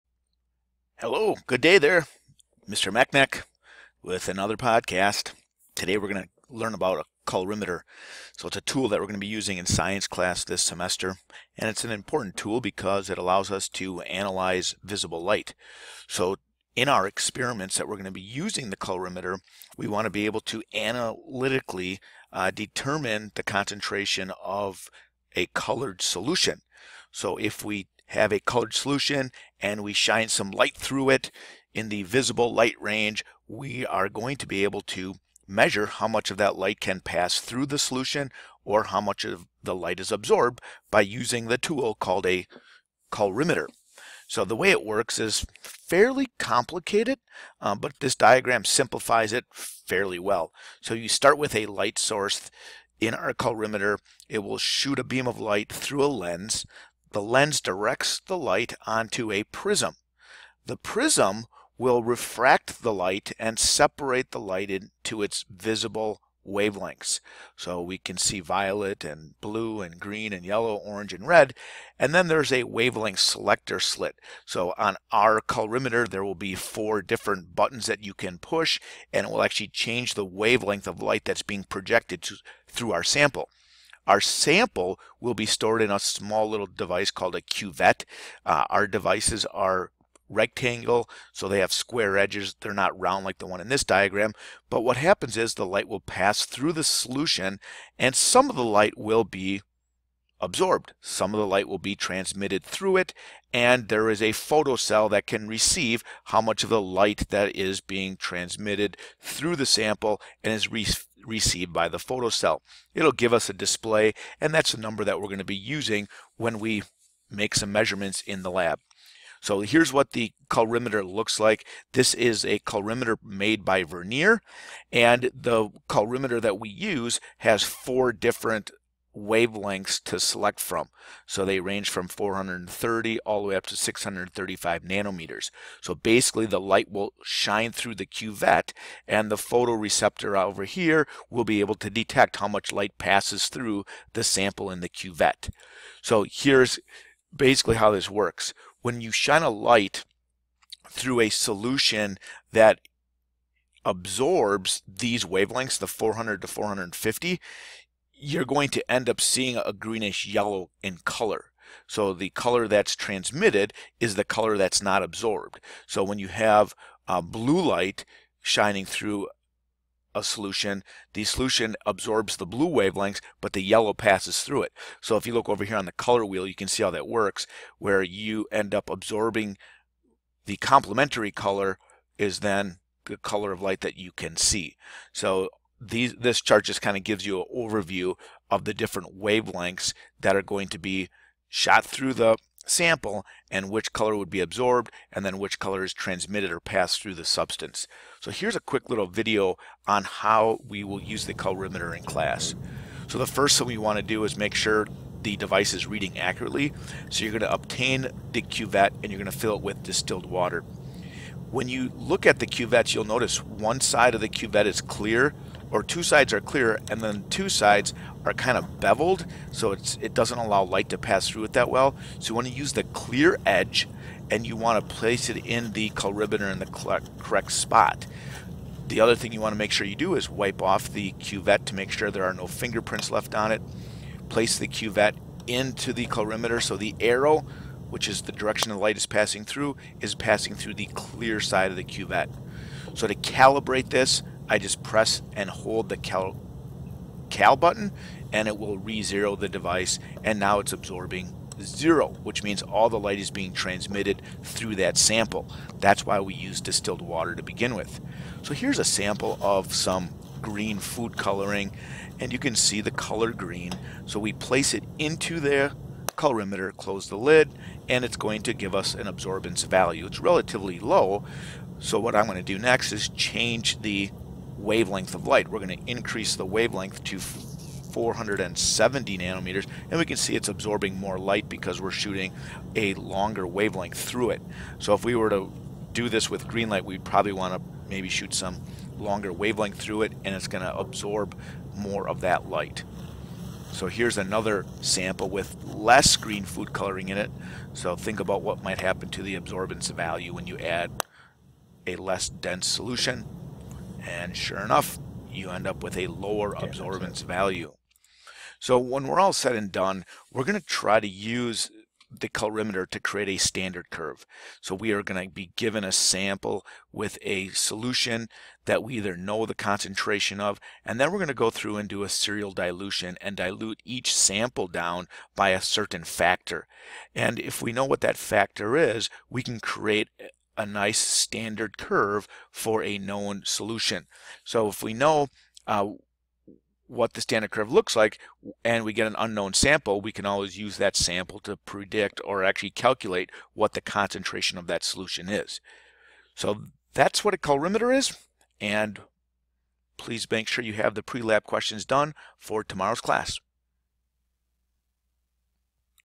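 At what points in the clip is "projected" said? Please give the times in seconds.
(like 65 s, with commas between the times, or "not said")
81 s.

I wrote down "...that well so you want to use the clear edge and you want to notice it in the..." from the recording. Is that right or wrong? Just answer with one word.
wrong.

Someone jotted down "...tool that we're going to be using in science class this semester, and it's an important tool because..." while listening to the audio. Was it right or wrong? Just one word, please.
right.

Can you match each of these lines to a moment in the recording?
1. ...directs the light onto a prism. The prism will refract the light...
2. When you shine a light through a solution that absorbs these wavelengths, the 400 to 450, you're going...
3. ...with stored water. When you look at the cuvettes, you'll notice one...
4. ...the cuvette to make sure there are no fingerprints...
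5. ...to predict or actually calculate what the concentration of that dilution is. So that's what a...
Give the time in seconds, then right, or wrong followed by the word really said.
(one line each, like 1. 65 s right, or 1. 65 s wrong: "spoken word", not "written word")
1. 57 s right
2. 148 s right
3. 209 s wrong: "distilled", not "stored"
4. 230 s right
5. 341 s wrong: "solution", not "dilution".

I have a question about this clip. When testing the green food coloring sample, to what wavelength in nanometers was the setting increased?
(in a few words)
470.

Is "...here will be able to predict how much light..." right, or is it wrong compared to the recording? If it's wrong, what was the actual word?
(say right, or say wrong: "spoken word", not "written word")
wrong: "detect", not "predict".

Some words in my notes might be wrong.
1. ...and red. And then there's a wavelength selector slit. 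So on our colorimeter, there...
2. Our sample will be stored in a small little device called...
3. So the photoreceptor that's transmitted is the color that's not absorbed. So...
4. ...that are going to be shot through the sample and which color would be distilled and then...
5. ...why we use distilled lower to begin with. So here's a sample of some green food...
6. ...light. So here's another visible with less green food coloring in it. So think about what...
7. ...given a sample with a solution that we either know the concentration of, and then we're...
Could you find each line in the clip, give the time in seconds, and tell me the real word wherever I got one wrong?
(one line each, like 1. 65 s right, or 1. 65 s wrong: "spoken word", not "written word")
1. 71 s right
2. 84 s right
3. 161 s wrong: "color", not "photoreceptor"
4. 190 s wrong: "absorbed", not "distilled"
5. 256 s wrong: "water", not "lower"
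6. 292 s wrong: "sample", not "visible"
7. 315 s right.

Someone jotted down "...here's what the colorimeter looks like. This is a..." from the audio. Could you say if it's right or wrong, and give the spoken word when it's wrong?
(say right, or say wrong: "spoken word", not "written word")
right.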